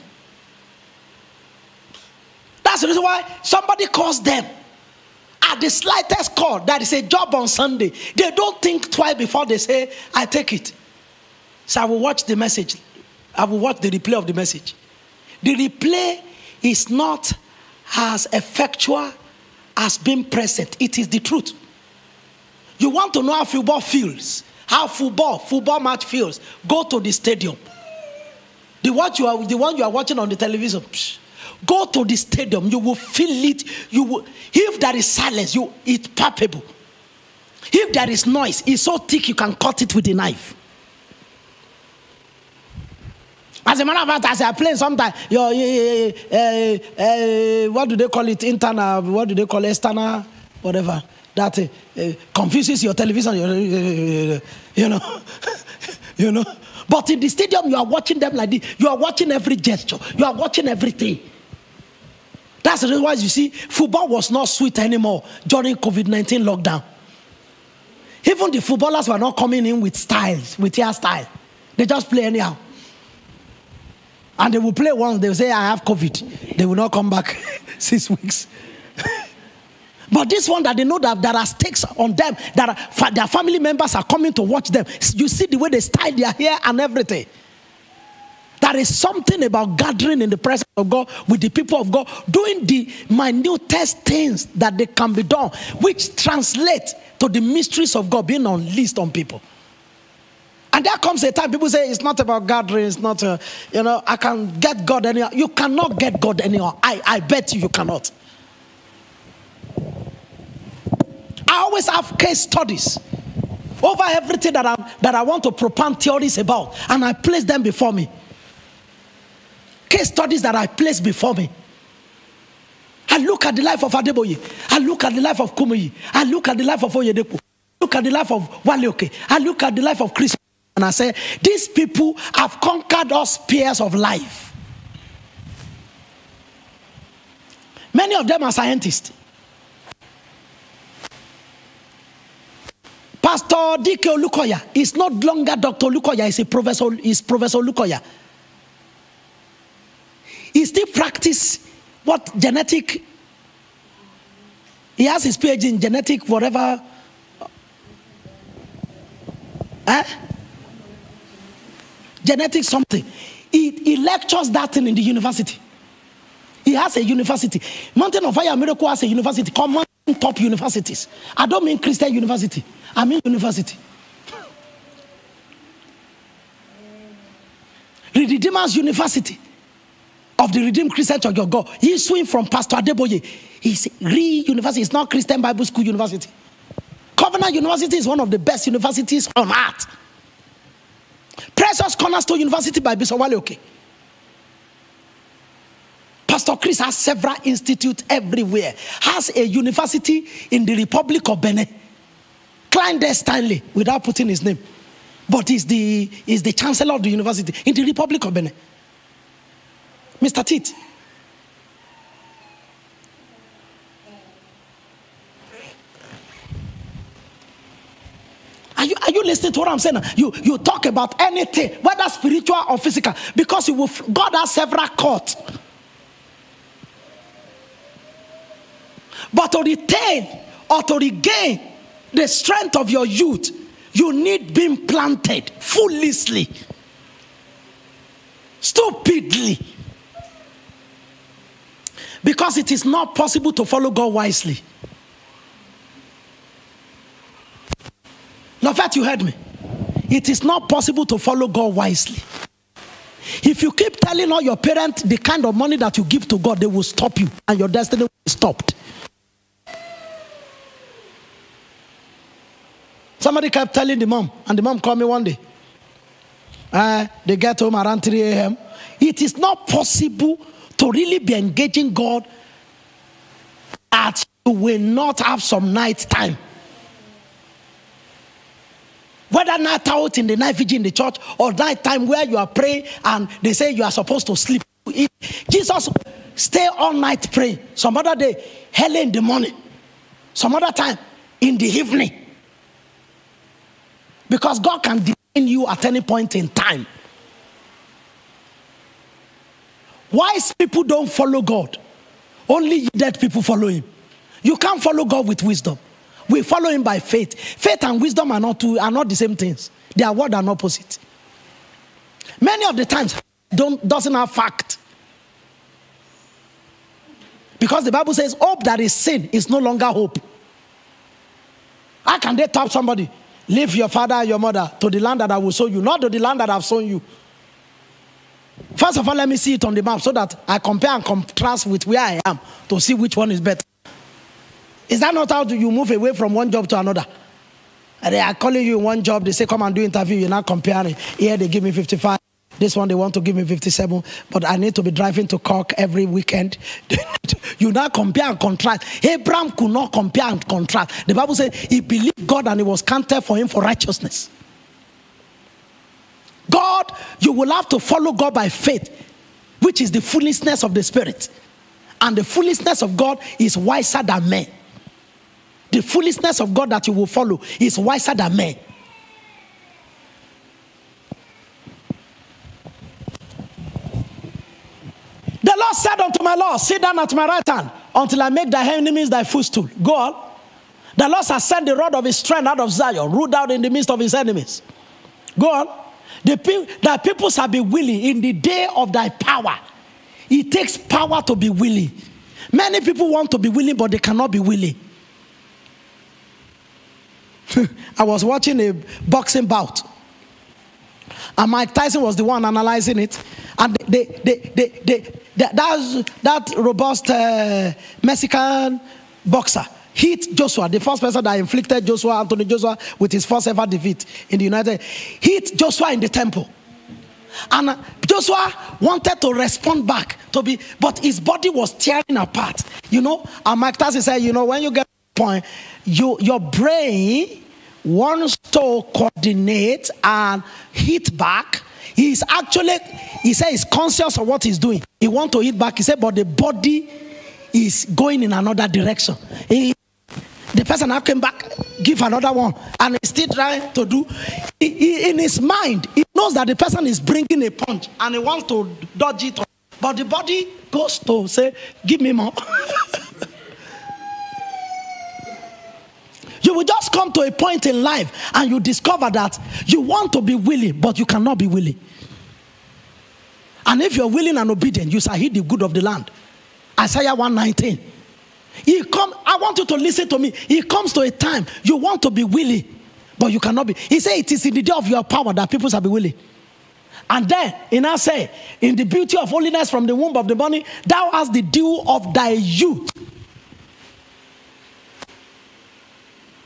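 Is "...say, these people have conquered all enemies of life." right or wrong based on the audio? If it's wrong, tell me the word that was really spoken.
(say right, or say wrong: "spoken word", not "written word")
wrong: "spheres", not "enemies".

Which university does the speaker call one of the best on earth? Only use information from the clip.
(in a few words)
Covenant University.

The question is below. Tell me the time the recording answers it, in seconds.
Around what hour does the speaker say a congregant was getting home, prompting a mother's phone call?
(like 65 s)
268 s.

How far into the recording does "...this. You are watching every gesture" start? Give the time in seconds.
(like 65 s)
58 s.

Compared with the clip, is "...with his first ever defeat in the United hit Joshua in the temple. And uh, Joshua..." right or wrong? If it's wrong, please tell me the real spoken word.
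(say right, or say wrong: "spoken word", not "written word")
right.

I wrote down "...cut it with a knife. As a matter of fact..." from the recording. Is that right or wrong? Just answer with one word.
right.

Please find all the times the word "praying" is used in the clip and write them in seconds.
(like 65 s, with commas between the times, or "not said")
282 s, 287 s.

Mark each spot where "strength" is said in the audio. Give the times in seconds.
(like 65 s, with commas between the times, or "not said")
232 s, 382 s.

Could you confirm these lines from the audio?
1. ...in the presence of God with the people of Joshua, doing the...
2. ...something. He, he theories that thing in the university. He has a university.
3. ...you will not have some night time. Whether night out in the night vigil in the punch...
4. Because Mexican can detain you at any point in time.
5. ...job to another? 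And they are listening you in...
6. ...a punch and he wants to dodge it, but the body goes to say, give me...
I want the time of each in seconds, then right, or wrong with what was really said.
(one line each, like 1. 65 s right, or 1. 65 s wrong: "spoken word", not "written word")
1. 90 s wrong: "God", not "Joshua"
2. 162 s wrong: "lectures", not "theories"
3. 274 s wrong: "church", not "punch"
4. 294 s wrong: "God", not "Mexican"
5. 336 s wrong: "calling", not "listening"
6. 447 s right.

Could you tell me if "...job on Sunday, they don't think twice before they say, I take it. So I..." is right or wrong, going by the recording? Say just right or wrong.
right.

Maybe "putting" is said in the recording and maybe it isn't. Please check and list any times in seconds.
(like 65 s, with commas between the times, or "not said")
204 s.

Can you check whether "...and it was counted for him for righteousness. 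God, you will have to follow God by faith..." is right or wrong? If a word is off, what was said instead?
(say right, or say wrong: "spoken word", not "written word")
right.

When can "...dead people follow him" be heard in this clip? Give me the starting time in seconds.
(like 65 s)
302 s.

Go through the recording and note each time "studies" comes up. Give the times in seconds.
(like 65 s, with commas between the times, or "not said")
112 s, 120 s.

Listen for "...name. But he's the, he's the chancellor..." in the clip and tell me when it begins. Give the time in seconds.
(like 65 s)
204 s.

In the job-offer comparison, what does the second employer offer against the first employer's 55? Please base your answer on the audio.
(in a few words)
57.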